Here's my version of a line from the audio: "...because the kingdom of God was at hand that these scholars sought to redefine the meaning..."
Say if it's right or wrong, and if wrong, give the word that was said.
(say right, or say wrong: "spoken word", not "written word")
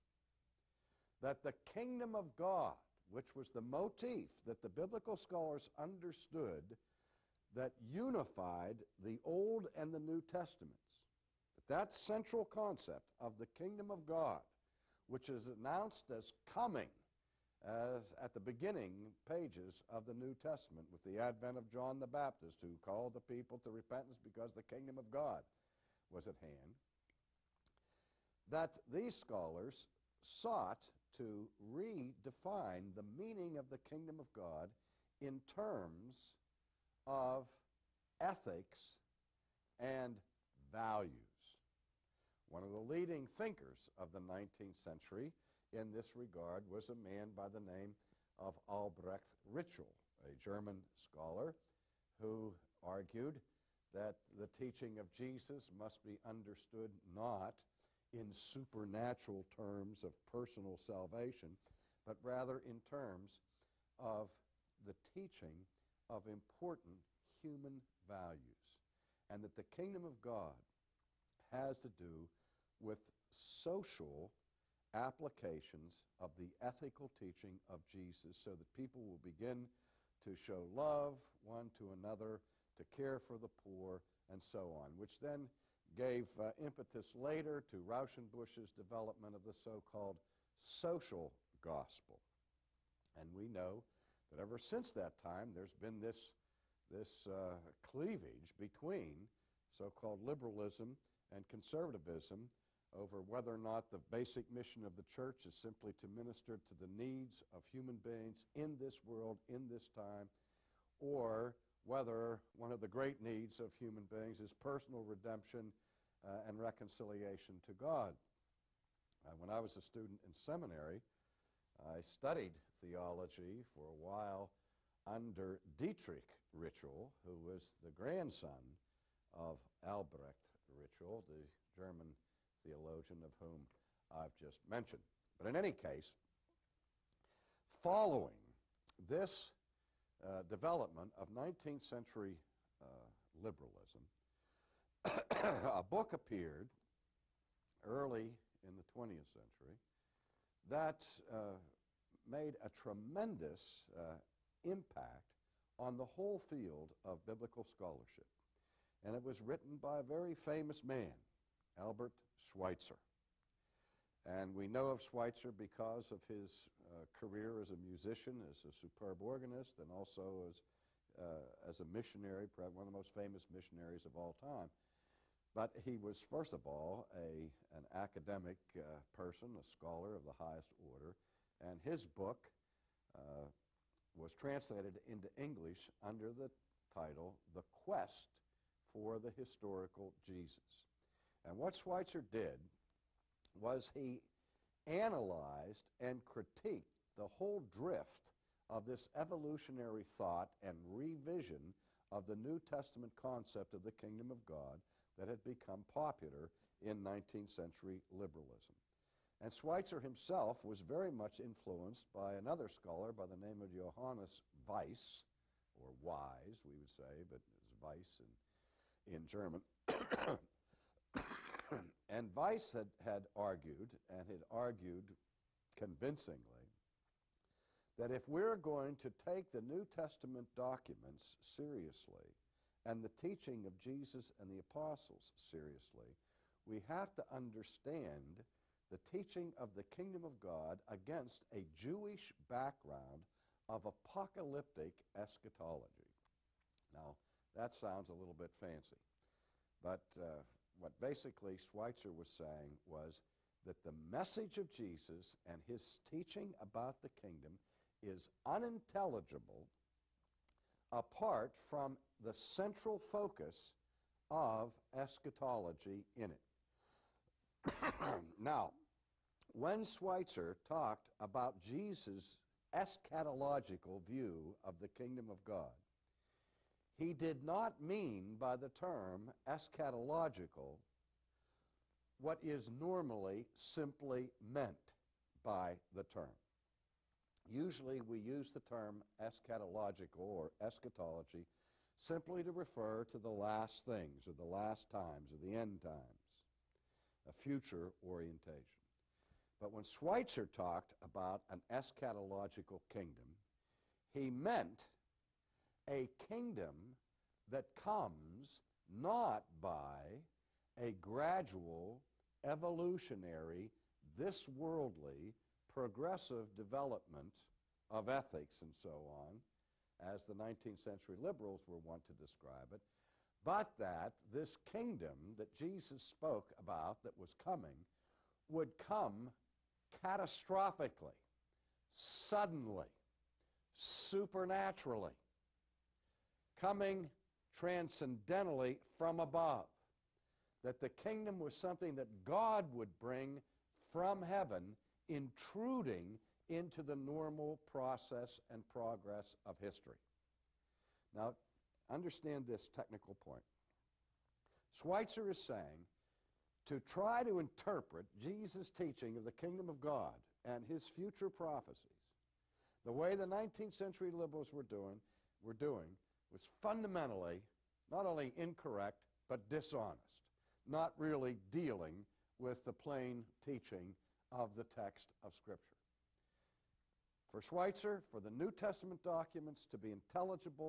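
right.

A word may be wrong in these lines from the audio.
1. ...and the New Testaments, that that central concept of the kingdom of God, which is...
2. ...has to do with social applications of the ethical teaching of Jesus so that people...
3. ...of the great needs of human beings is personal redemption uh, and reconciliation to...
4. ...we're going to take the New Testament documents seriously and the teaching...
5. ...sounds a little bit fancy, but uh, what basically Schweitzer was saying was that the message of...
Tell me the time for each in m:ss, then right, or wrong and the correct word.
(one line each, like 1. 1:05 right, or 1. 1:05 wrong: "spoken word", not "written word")
1. 0:09 right
2. 1:11 right
3. 1:52 right
4. 3:48 right
5. 4:07 right.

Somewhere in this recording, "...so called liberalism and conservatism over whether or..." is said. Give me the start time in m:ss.
1:39.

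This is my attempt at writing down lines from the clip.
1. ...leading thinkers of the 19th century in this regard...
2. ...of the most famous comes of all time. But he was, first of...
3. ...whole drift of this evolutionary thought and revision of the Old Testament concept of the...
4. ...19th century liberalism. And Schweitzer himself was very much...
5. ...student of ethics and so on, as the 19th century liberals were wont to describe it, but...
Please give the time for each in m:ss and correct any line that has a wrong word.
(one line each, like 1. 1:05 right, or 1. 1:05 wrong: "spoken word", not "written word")
1. 0:42 right
2. 2:52 wrong: "missionaries", not "comes"
3. 3:17 wrong: "New", not "Old"
4. 3:27 right
5. 5:16 wrong: "development", not "student".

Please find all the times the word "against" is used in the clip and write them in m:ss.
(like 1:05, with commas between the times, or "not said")
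4:00.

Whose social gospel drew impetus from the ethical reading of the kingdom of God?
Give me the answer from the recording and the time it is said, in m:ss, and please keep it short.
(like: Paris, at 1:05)
Rauschenbusch, at 1:27.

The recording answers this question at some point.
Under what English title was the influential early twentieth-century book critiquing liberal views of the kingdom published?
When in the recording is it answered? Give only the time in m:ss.
3:07.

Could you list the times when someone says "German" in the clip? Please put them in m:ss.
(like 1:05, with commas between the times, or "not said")
0:50, 2:11, 3:39.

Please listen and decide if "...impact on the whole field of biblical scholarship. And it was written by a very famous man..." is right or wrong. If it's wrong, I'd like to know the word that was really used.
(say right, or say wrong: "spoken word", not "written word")
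right.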